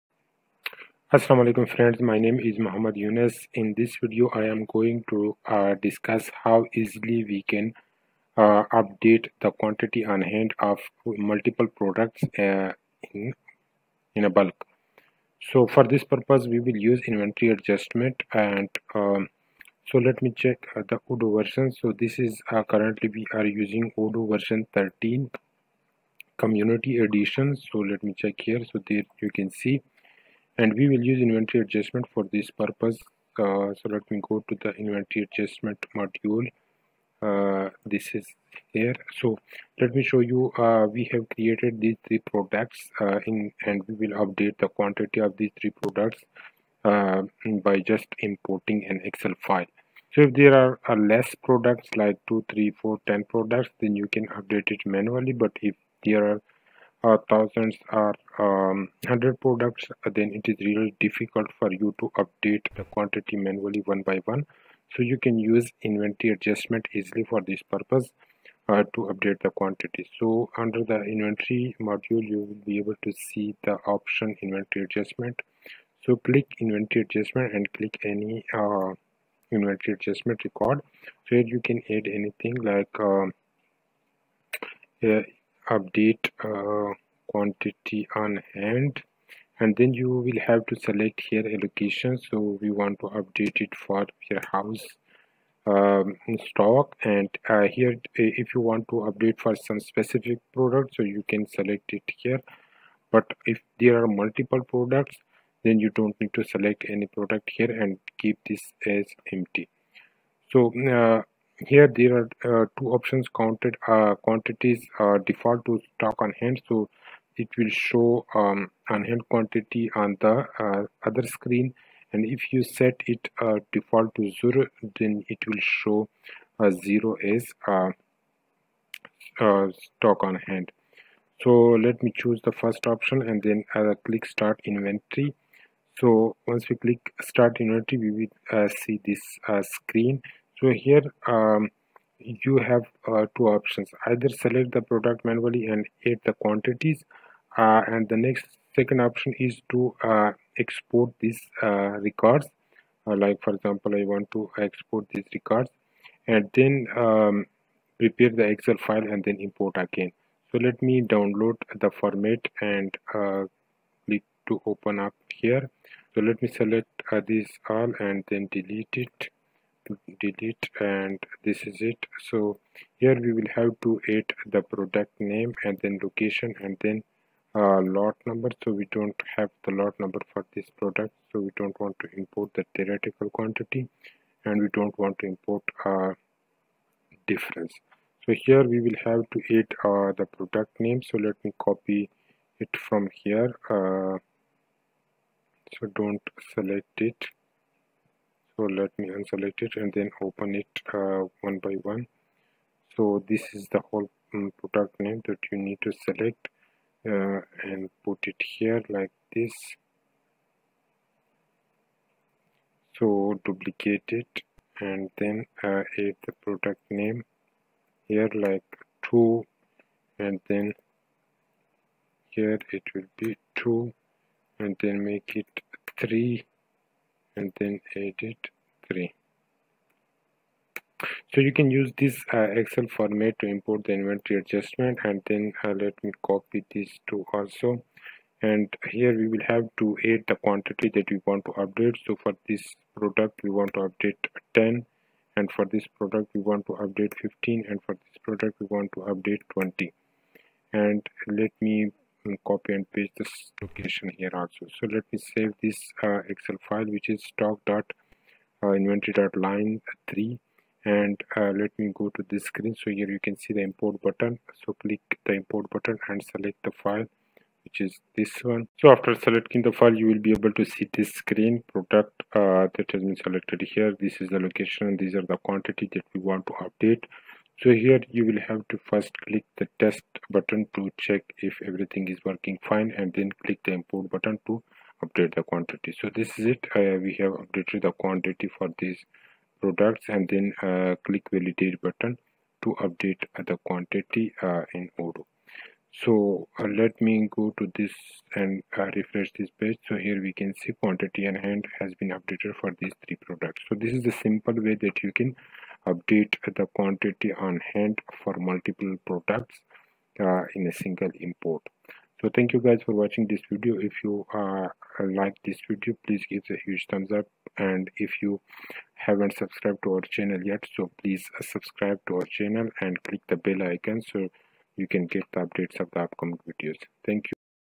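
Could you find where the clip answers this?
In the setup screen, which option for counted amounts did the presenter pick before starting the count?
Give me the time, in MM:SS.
01:55.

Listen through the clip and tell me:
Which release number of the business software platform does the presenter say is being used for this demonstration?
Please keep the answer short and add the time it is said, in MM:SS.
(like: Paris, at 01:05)
13, at 00:23.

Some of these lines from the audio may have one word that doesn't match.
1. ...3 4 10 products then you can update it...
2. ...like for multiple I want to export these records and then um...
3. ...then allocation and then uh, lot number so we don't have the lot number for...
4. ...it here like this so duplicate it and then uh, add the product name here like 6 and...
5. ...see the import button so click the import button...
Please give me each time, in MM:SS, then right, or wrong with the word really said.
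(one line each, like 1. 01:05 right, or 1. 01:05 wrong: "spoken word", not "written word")
1. 00:52 right
2. 02:33 wrong: "example", not "multiple"
3. 02:55 wrong: "location", not "allocation"
4. 03:28 wrong: "2", not "6"
5. 04:23 right.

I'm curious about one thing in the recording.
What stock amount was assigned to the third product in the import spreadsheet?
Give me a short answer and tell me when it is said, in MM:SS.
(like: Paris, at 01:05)
20, at 04:09.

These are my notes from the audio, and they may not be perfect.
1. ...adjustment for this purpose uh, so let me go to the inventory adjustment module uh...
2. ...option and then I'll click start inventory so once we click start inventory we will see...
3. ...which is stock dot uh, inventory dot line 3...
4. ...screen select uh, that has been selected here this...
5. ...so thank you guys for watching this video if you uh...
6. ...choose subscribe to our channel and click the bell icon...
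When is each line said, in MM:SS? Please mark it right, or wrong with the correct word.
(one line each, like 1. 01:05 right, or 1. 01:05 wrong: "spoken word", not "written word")
1. 00:31 right
2. 02:12 right
3. 04:16 right
4. 04:31 wrong: "product", not "select"
5. 05:12 right
6. 05:21 wrong: "please", not "choose".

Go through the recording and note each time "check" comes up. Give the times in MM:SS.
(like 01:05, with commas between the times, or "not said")
00:20, 00:28, 04:40.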